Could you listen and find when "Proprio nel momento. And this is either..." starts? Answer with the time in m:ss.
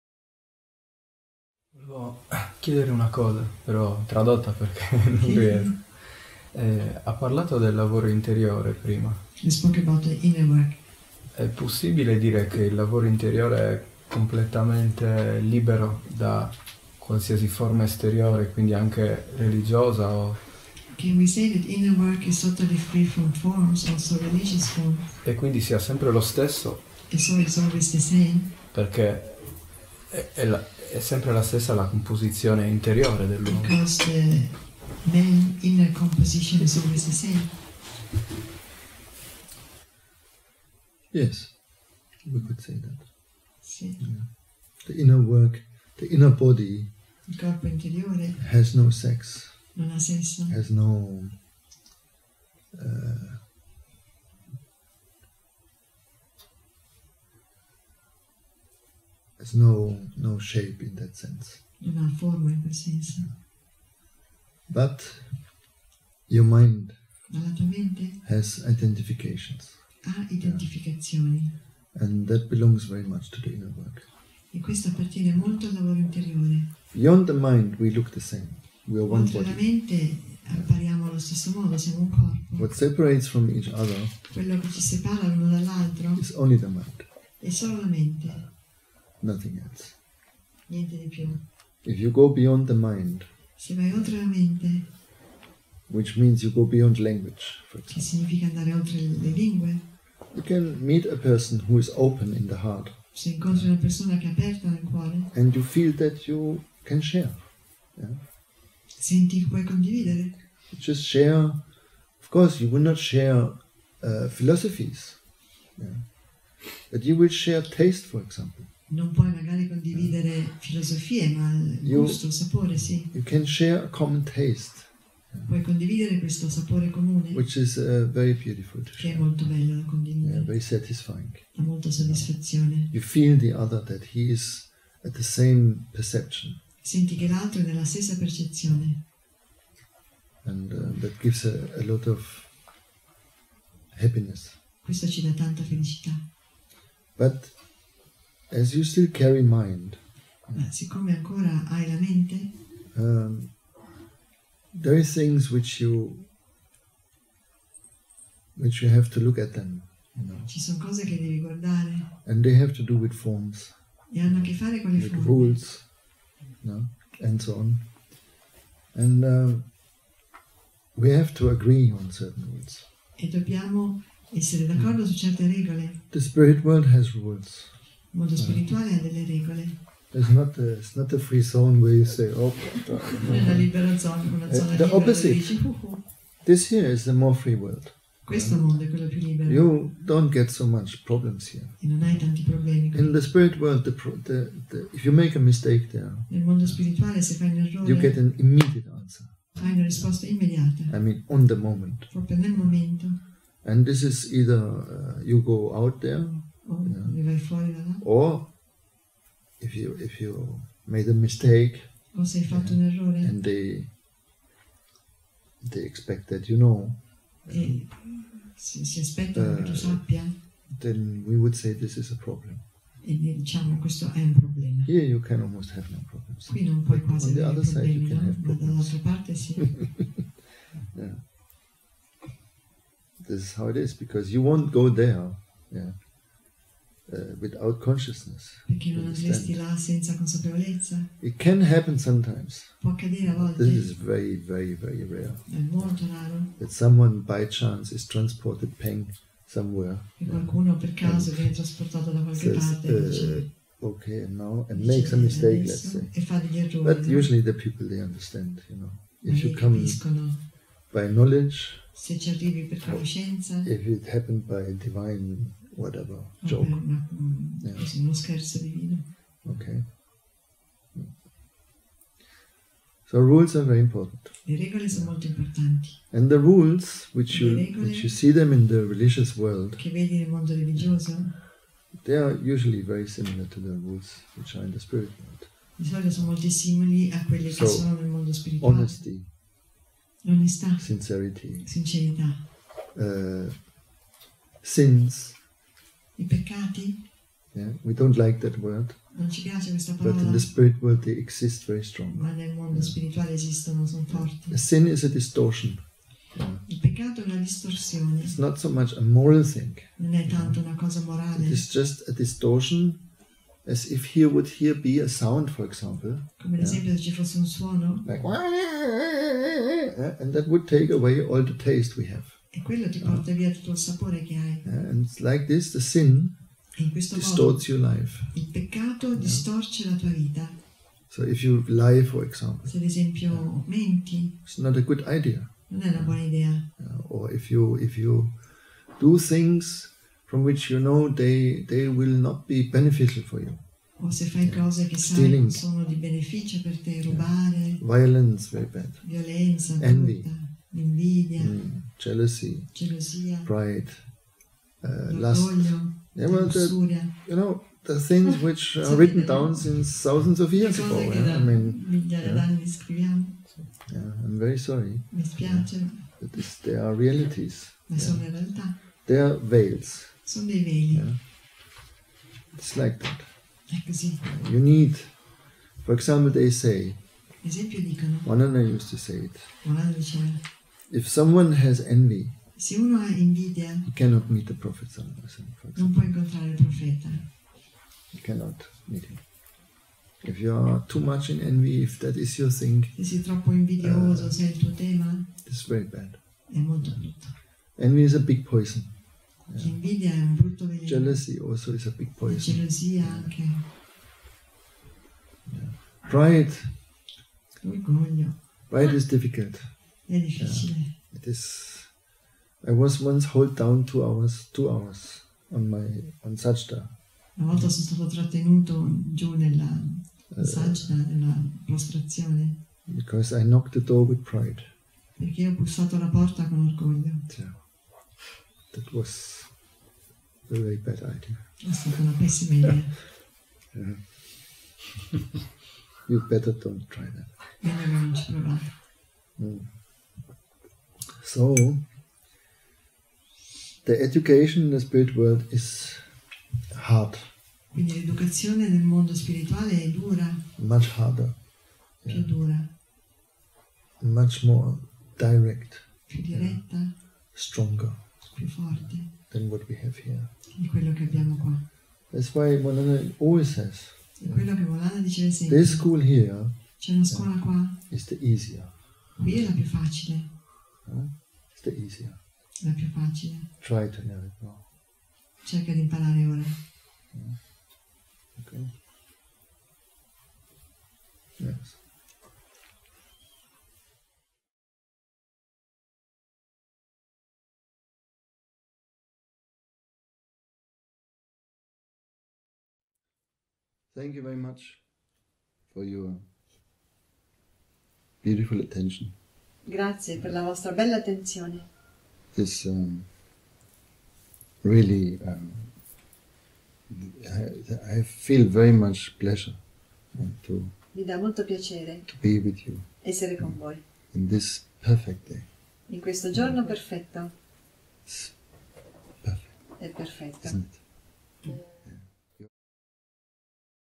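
3:22.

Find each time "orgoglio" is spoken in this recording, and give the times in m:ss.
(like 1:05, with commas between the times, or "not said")
7:06.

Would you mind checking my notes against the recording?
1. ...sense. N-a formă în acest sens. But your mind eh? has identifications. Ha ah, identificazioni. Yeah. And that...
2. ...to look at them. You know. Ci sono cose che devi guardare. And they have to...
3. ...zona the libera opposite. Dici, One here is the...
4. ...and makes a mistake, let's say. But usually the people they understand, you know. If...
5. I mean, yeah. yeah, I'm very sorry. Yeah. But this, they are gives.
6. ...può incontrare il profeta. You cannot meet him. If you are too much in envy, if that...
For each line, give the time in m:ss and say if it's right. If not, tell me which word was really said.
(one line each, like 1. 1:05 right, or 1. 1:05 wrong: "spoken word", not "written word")
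1. 1:01 right
2. 2:39 right
3. 3:04 wrong: "This", not "One"
4. 4:14 right
5. 6:01 wrong: "realities", not "gives"
6. 6:25 right.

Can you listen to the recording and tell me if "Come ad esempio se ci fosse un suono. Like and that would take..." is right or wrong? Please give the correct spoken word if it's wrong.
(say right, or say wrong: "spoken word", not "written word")
right.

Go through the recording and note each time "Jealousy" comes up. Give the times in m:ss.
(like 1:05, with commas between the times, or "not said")
5:51, 6:40.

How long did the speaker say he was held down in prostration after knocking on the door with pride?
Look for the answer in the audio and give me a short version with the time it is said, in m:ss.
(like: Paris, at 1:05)
2 hours, at 6:53.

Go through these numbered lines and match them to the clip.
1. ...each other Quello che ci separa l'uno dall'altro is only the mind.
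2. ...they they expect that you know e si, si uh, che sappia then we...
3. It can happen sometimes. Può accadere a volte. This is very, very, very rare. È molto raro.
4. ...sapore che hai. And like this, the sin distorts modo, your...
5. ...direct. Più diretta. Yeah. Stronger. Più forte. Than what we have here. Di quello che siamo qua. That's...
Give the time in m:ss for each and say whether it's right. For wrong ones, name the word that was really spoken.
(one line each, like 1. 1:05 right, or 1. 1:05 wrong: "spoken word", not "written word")
1. 1:23 right
2. 3:33 right
3. 4:01 right
4. 5:23 right
5. 7:35 wrong: "abbiamo", not "siamo".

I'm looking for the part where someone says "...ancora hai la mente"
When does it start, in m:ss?
2:31.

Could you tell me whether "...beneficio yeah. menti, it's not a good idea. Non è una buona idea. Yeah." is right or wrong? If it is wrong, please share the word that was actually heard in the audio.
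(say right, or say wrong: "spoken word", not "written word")
wrong: "esempio", not "beneficio".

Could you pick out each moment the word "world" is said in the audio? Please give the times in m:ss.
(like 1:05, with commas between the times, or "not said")
2:56, 3:07, 3:13, 4:39, 4:45, 5:00, 7:25.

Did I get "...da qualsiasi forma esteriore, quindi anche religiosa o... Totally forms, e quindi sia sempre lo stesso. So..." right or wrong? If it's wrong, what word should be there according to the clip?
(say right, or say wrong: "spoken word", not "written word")
right.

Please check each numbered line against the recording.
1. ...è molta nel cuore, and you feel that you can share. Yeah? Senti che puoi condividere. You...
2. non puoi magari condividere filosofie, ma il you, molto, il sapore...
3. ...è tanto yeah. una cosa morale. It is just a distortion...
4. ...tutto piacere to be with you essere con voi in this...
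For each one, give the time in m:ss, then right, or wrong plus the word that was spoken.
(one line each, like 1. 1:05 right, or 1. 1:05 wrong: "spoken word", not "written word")
1. 1:44 wrong: "aperta", not "molta"
2. 1:58 wrong: "gusto", not "molto"
3. 5:10 right
4. 8:31 wrong: "molto", not "tutto".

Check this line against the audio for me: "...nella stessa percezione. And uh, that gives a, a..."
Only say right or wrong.
right.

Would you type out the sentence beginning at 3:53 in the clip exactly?
this is how it is because you won't go there uh, without consciousness.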